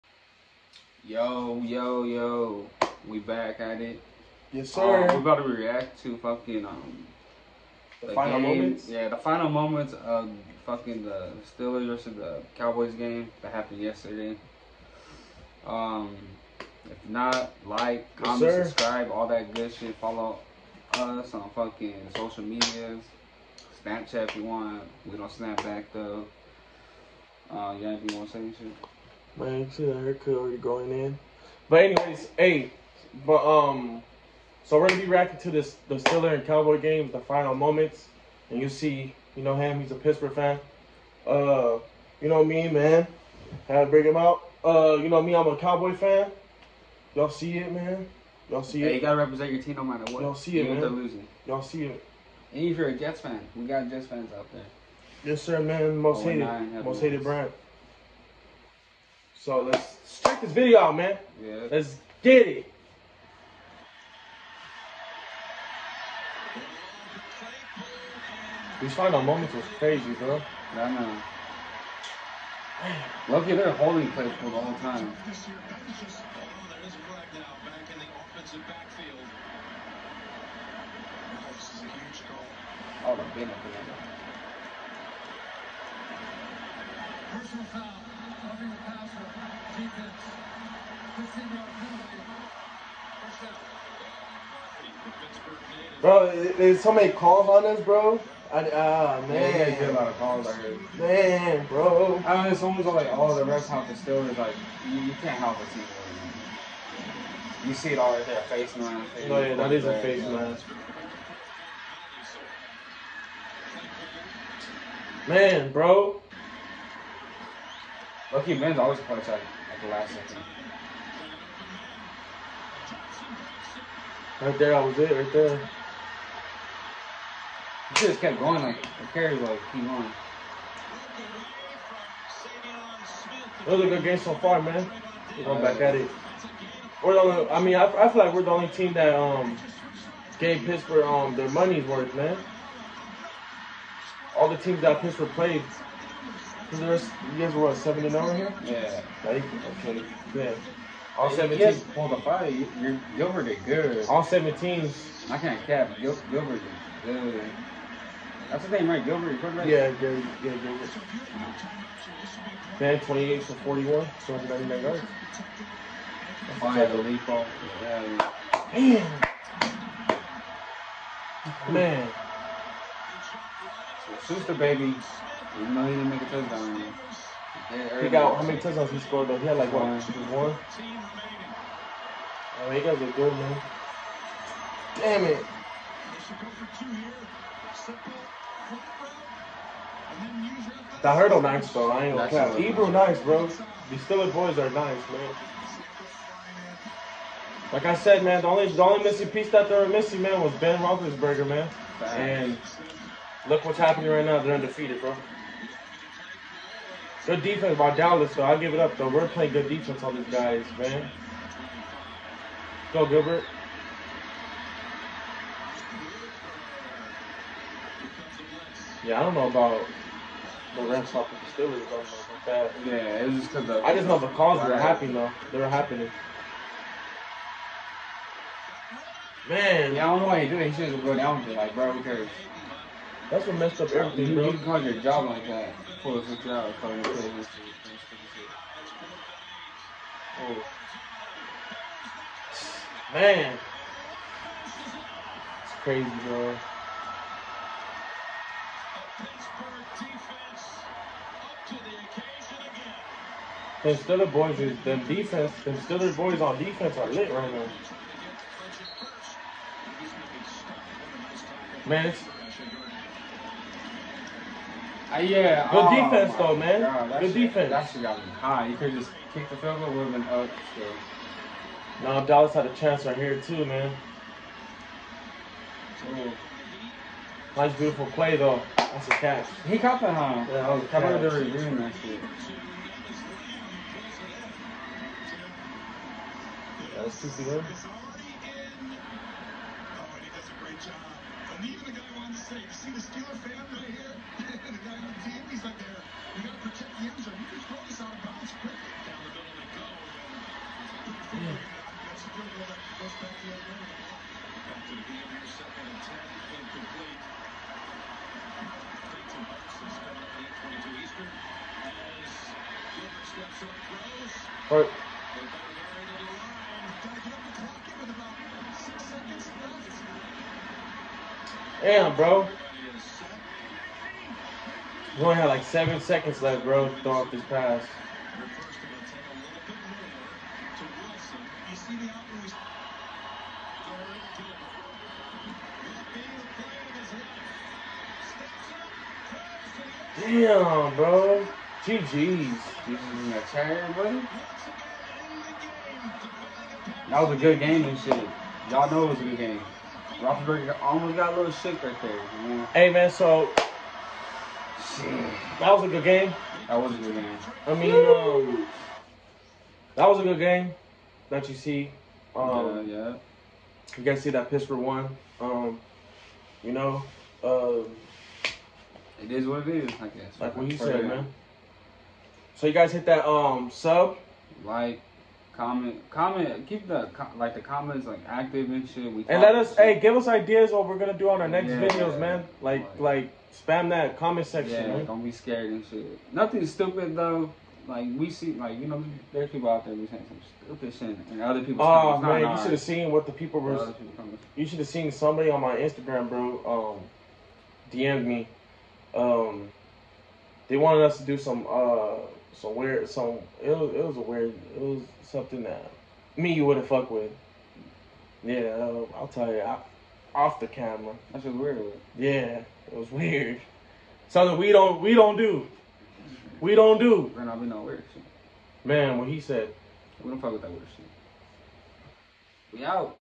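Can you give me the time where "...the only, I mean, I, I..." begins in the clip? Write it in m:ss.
2:17.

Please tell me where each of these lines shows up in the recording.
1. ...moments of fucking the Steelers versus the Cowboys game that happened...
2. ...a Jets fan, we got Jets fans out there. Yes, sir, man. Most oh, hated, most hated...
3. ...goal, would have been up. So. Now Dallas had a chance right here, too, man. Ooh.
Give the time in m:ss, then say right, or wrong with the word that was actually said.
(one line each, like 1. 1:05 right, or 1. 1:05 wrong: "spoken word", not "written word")
1. 0:09 right
2. 0:52 right
3. 4:29 right.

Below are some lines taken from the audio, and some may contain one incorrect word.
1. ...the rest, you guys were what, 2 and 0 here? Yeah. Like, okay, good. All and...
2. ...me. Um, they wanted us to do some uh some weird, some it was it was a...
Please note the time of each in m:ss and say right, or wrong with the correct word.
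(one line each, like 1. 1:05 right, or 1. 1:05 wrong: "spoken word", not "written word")
1. 2:26 wrong: "7", not "2"
2. 6:38 right.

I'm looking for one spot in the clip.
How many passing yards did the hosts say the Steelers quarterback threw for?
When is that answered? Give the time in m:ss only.
2:44.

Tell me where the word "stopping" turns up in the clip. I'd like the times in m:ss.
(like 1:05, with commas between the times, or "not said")
3:41.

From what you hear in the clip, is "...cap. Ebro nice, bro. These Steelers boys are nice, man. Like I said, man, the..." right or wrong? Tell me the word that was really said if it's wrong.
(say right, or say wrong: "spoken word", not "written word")
right.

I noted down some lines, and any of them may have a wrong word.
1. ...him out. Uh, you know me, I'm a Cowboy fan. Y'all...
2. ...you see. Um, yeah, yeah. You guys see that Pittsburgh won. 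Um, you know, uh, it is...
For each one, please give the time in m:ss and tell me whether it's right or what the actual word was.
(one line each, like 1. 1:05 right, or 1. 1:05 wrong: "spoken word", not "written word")
1. 0:44 right
2. 6:01 right.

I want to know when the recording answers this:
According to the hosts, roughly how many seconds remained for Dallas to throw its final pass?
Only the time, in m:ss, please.
5:25.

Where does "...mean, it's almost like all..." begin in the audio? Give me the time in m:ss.
1:42.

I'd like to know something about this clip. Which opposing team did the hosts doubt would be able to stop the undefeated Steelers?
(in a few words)
the Rams.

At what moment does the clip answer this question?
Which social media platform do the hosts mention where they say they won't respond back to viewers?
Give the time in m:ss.
0:23.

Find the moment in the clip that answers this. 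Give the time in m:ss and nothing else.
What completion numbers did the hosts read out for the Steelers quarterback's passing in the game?
2:43.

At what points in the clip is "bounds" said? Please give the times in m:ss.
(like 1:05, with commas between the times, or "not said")
4:58.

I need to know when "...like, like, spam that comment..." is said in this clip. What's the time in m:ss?
6:22.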